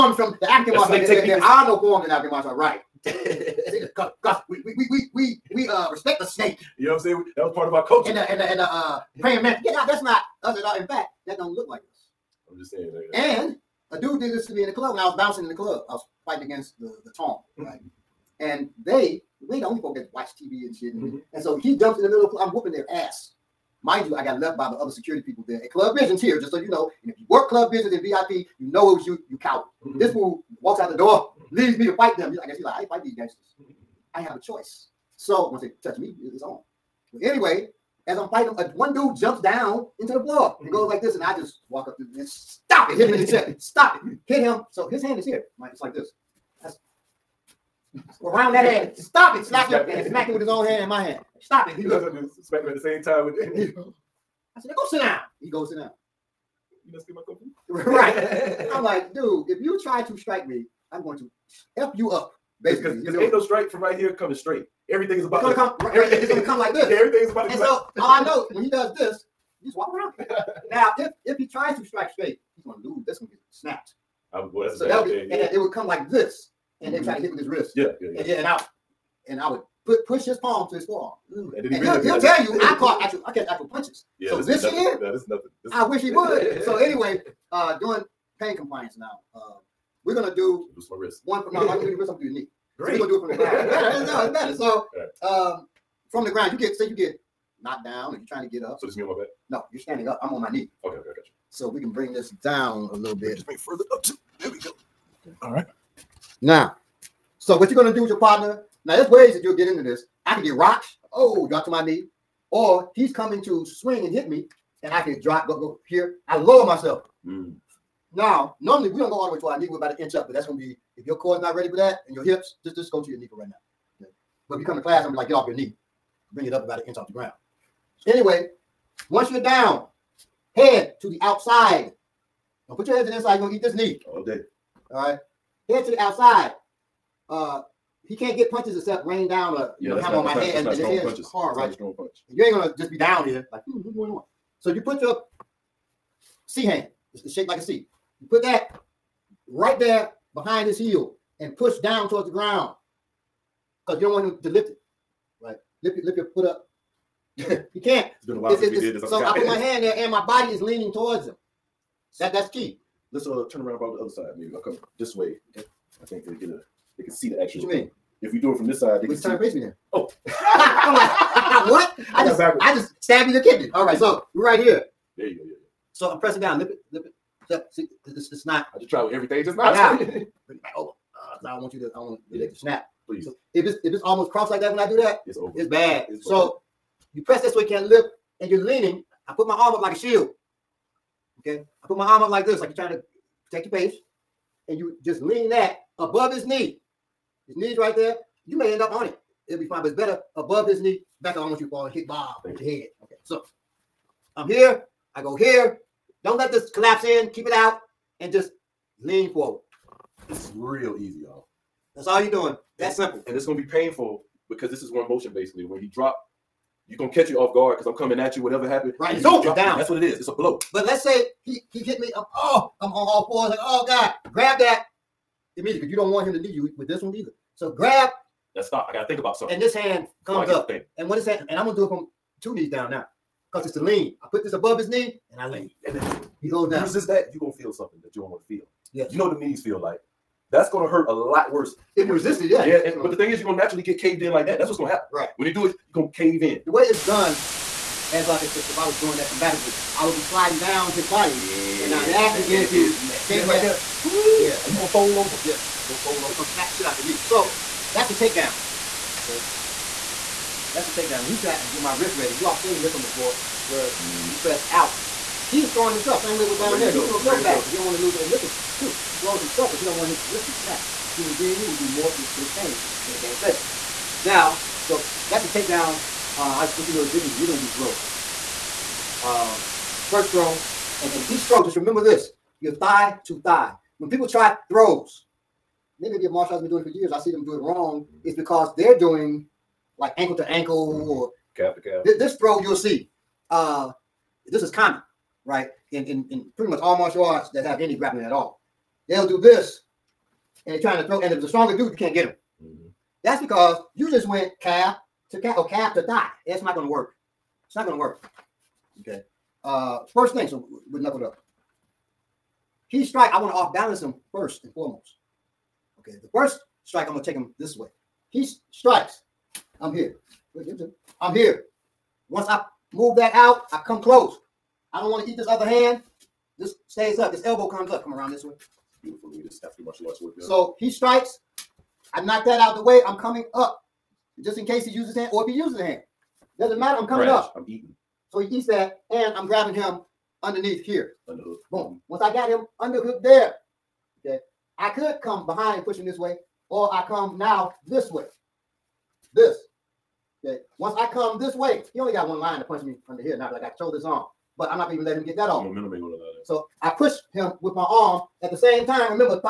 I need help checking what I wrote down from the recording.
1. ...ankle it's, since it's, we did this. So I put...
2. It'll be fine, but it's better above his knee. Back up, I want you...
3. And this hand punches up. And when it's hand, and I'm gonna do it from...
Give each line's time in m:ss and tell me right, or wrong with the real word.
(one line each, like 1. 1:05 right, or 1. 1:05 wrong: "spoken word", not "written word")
1. 2:38 wrong: "while", not "ankle"
2. 3:19 right
3. 3:49 wrong: "comes", not "punches".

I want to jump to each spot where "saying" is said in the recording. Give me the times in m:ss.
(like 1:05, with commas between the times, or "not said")
0:07, 0:12.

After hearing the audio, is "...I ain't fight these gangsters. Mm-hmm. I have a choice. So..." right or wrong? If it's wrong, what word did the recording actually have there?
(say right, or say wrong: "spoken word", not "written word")
right.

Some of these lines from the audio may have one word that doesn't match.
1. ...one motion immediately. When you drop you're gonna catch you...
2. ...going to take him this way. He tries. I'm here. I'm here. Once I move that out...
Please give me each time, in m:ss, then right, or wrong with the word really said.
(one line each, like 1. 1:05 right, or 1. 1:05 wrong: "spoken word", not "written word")
1. 3:34 wrong: "basically", not "immediately"
2. 5:17 wrong: "strikes", not "tries".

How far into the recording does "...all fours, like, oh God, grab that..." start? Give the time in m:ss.
3:43.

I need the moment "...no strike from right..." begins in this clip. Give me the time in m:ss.
1:03.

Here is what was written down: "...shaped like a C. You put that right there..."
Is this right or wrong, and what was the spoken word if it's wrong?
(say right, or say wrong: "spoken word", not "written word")
right.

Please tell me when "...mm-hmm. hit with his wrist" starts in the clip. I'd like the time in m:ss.
1:17.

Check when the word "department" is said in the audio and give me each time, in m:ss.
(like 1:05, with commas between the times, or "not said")
not said.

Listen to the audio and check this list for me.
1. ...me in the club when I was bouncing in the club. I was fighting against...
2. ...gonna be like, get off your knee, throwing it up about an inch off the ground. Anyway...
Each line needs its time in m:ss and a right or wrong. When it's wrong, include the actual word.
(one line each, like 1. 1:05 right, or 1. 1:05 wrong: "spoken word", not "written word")
1. 0:14 right
2. 2:05 wrong: "bring", not "throwing".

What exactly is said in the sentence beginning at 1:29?
Uh, we're gonna do do my wrist.